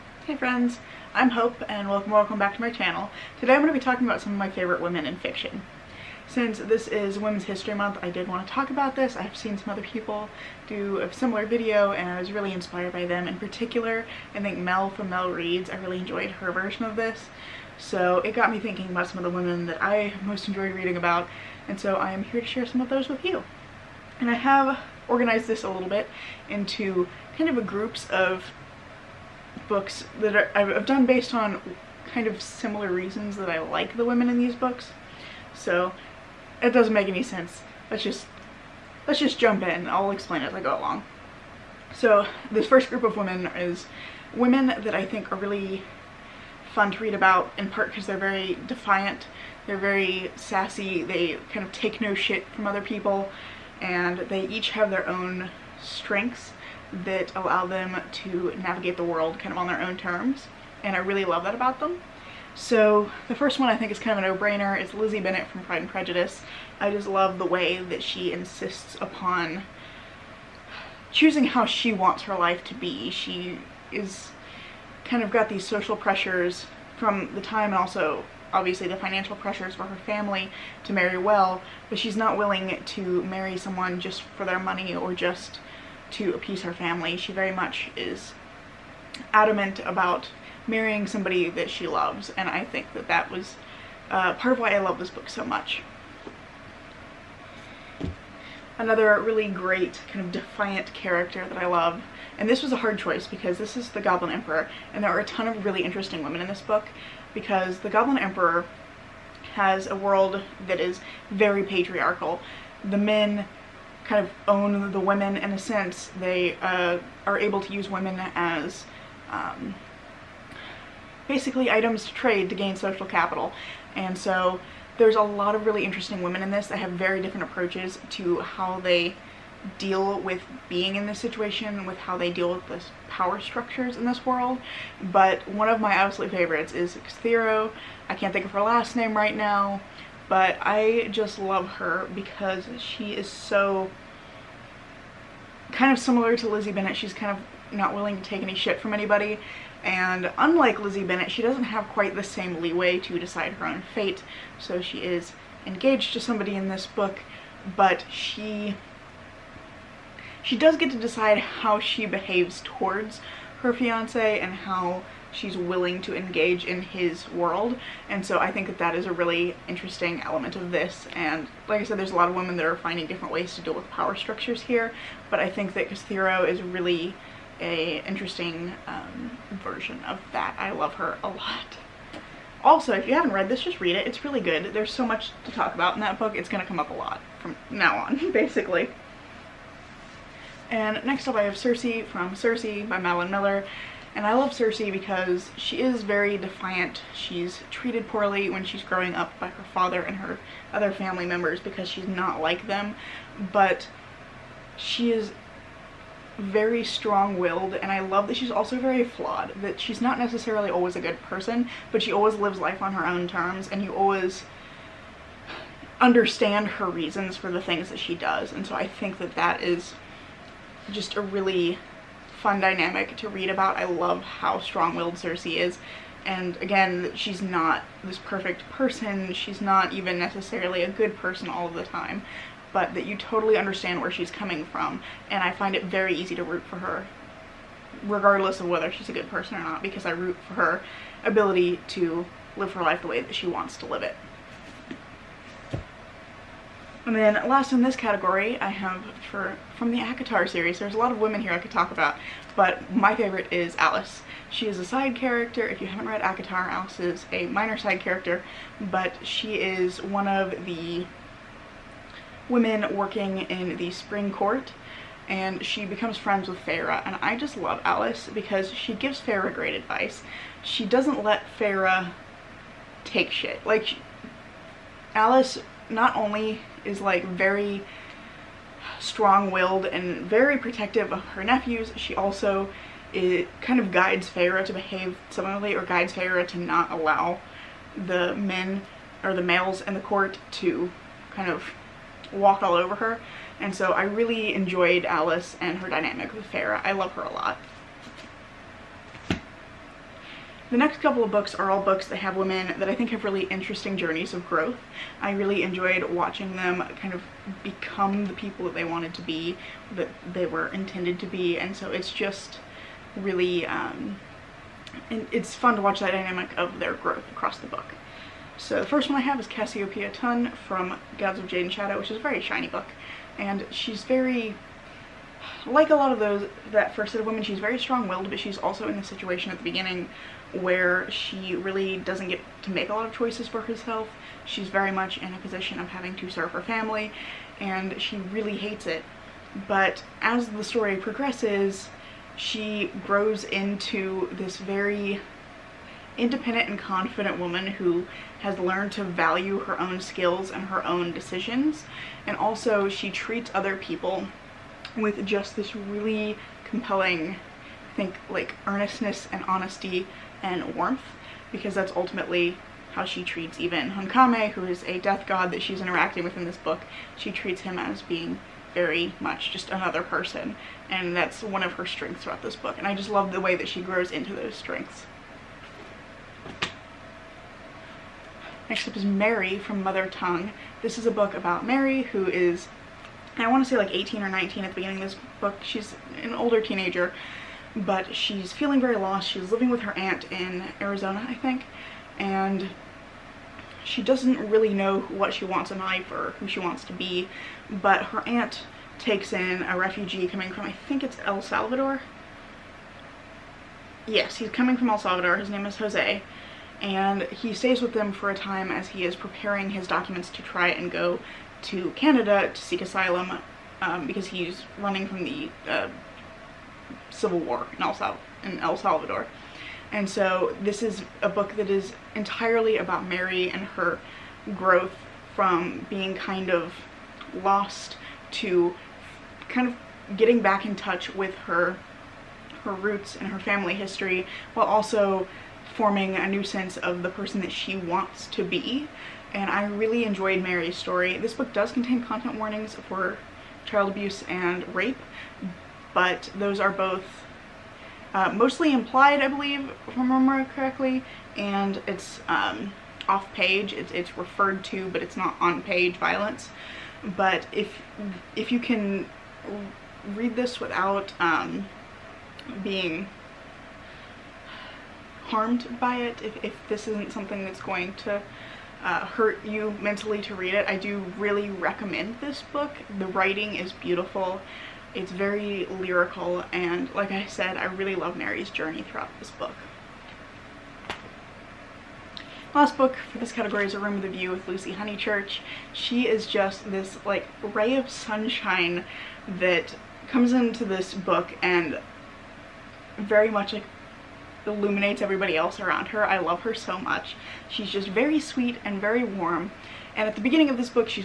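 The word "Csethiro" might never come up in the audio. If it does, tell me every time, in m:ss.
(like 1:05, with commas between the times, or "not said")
2:16, 2:55.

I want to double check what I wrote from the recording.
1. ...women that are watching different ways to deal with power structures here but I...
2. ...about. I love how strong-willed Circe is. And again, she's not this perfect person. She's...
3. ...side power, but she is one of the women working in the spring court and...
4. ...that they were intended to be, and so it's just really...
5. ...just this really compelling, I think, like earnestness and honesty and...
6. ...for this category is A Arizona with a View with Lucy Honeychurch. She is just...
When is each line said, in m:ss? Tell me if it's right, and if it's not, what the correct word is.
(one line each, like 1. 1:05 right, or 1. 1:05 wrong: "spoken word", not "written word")
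1. 2:52 wrong: "finding", not "watching"
2. 3:43 right
3. 4:17 wrong: "character", not "power"
4. 5:09 right
5. 5:55 right
6. 8:03 wrong: "Room", not "Arizona".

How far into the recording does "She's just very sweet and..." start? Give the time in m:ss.
8:17.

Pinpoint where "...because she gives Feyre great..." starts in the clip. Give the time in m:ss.
4:28.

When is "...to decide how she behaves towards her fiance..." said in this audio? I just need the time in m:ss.
2:40.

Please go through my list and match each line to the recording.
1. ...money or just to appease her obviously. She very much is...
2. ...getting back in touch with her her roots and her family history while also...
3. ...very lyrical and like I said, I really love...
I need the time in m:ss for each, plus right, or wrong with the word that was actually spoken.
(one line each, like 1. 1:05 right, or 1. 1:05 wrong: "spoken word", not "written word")
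1. 1:24 wrong: "family", not "obviously"
2. 7:10 right
3. 7:55 right.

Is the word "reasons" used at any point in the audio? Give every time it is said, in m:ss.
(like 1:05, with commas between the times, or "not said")
0:32, 3:36.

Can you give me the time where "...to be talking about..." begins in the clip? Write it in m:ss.
0:03.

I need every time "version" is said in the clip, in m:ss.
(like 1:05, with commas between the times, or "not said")
0:16, 2:59.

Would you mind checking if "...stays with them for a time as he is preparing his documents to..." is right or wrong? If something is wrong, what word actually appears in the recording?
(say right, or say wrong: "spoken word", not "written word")
right.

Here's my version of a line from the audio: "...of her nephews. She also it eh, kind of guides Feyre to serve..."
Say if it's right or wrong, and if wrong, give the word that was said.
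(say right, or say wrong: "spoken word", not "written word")
wrong: "behave", not "serve".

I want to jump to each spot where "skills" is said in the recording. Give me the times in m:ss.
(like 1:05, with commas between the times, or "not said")
5:49.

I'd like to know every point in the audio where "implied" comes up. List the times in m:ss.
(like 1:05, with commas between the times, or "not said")
7:28.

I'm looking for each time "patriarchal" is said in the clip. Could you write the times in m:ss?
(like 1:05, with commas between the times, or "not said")
1:51.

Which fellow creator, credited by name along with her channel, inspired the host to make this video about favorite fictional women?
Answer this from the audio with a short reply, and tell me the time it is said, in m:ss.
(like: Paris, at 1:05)
Mel from Mel Reads, at 0:14.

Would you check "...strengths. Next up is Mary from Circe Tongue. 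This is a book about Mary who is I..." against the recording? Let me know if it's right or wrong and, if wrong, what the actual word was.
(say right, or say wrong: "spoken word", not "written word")
wrong: "Mother", not "Circe".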